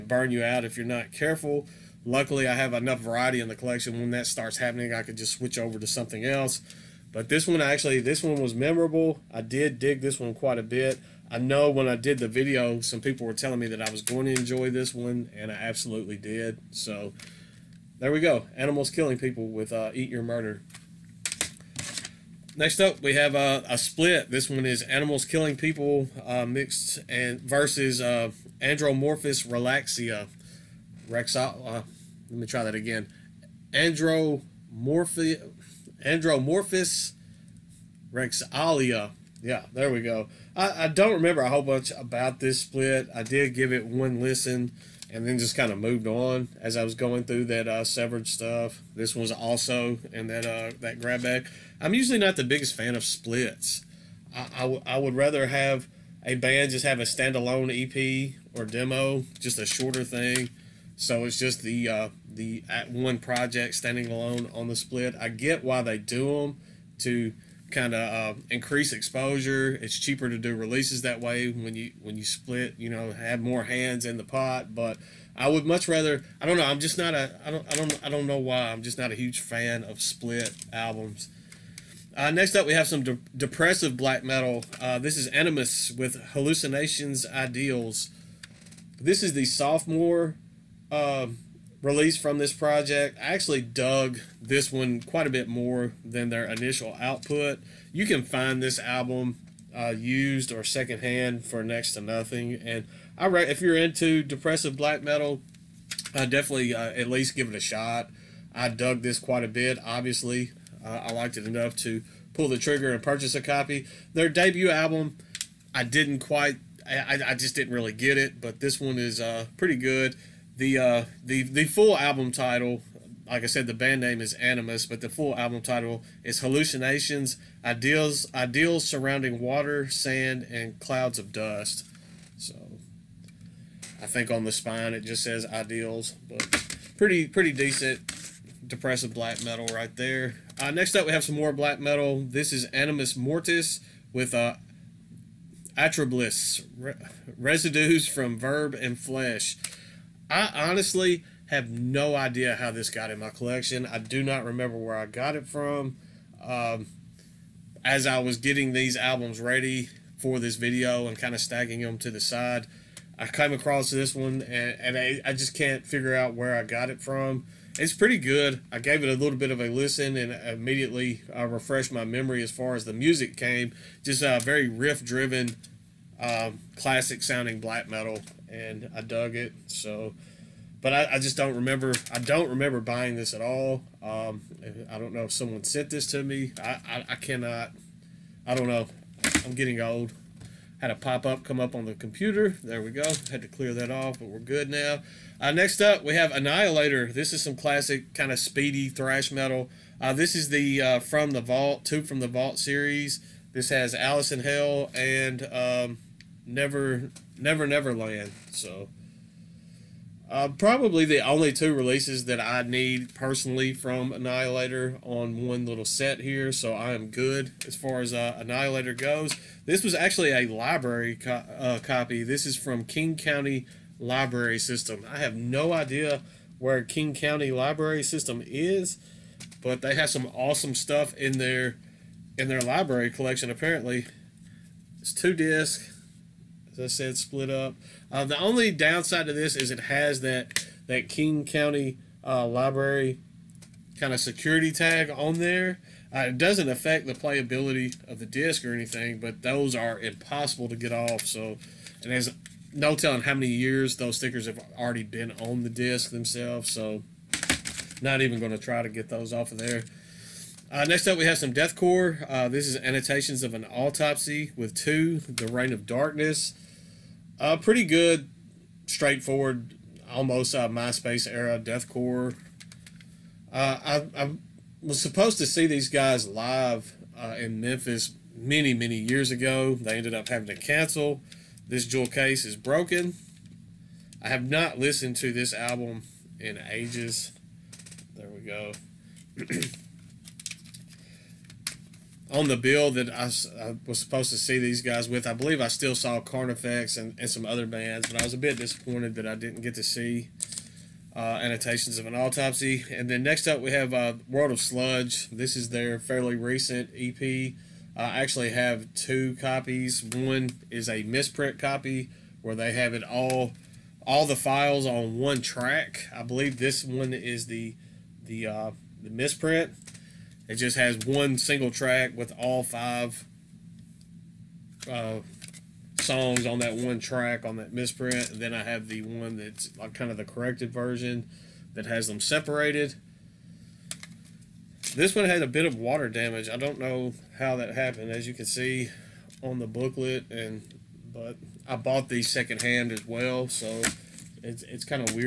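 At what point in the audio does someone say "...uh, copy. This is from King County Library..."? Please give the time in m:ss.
3:41.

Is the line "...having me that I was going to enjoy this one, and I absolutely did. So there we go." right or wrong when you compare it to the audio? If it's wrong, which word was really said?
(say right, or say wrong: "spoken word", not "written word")
wrong: "telling", not "having".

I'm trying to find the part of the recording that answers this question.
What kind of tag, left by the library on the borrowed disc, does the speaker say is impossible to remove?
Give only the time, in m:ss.
4:04.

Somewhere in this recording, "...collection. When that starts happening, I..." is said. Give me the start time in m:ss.
0:03.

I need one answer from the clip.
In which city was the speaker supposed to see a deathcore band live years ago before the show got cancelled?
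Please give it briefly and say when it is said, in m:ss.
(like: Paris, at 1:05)
Memphis, at 4:37.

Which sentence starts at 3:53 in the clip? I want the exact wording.
Apparently, it's two discs as I said, split up.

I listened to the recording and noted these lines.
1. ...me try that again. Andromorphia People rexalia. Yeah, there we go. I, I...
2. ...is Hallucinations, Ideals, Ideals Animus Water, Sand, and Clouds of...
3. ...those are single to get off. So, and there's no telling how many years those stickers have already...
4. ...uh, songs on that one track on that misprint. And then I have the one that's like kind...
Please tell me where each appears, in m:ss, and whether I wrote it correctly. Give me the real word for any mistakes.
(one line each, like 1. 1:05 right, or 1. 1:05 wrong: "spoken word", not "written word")
1. 0:32 wrong: "Andromorphus", not "People"
2. 2:06 wrong: "Surrounding", not "Animus"
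3. 4:09 wrong: "impossible", not "single"
4. 5:24 right.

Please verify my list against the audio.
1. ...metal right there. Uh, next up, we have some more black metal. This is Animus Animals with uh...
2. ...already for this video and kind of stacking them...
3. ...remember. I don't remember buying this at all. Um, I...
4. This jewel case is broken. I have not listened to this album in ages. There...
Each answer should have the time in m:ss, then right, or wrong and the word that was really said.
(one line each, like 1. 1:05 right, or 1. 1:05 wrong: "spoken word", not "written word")
1. 2:19 wrong: "Mortis", not "Animals"
2. 2:39 wrong: "ready", not "already"
3. 3:01 right
4. 4:41 right.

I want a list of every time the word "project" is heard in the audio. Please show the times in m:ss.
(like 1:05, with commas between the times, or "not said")
1:03, 1:32.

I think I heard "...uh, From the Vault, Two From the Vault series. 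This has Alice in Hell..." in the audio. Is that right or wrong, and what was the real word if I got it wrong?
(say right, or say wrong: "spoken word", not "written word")
right.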